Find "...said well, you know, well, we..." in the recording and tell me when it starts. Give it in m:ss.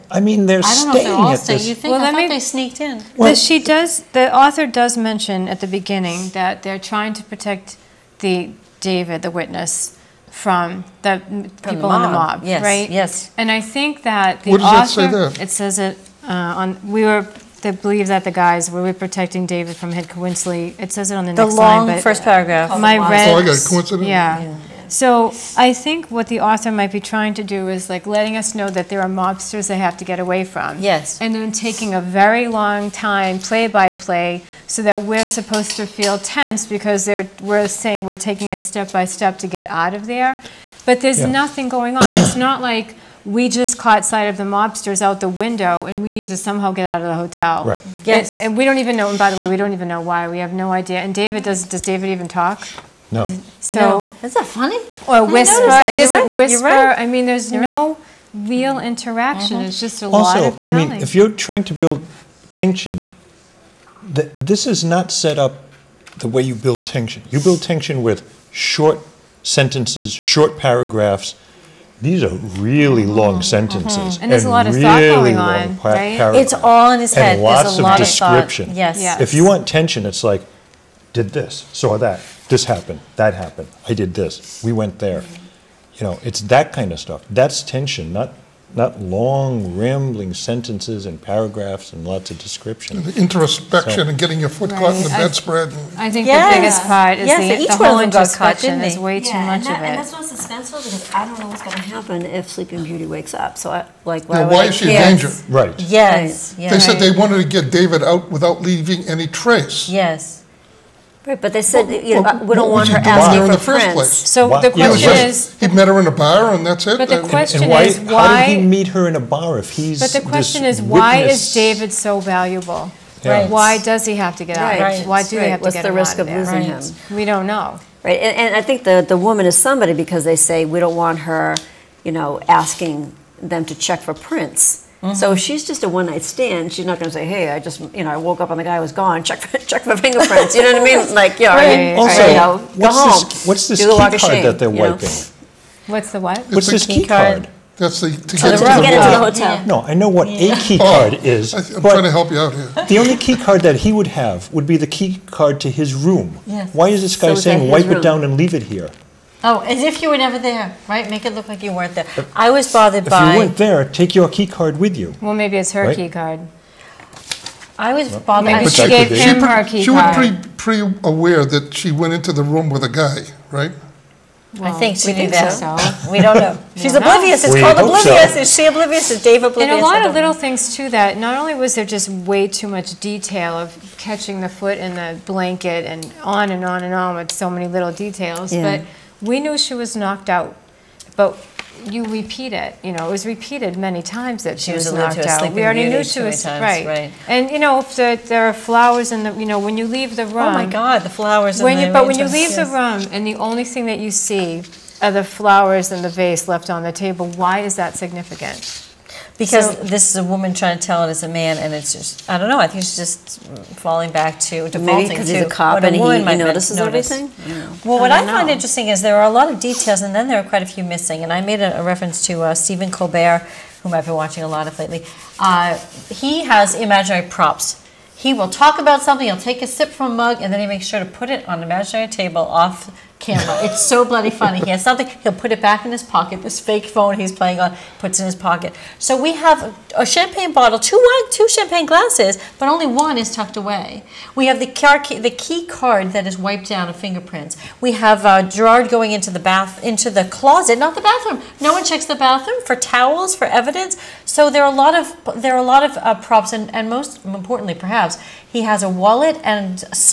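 1:51.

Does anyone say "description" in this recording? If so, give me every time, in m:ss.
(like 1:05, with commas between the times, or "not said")
1:18, 1:32.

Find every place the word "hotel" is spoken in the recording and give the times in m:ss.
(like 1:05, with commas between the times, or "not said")
0:47, 2:29.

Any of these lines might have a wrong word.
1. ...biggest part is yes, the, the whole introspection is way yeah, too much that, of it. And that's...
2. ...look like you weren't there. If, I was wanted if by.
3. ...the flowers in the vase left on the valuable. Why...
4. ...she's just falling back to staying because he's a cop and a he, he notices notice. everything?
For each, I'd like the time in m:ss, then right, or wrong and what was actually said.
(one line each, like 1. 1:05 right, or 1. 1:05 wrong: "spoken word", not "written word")
1. 1:36 right
2. 2:41 wrong: "bothered", not "wanted"
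3. 3:25 wrong: "table", not "valuable"
4. 3:32 wrong: "defaulting", not "staying".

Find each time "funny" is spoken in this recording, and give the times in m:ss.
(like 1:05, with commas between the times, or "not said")
0:54, 3:54.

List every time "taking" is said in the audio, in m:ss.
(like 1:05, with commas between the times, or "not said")
0:31, 0:38.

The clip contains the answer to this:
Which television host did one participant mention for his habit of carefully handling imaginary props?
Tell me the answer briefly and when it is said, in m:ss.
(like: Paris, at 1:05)
Stephen Colbert, at 3:42.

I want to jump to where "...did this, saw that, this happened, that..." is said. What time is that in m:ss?
1:21.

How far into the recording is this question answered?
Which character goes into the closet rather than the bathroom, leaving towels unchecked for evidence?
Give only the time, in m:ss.
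4:08.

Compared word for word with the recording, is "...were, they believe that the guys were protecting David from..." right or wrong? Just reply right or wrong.
right.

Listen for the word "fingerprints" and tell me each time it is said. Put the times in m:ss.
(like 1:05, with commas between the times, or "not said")
2:19, 4:06.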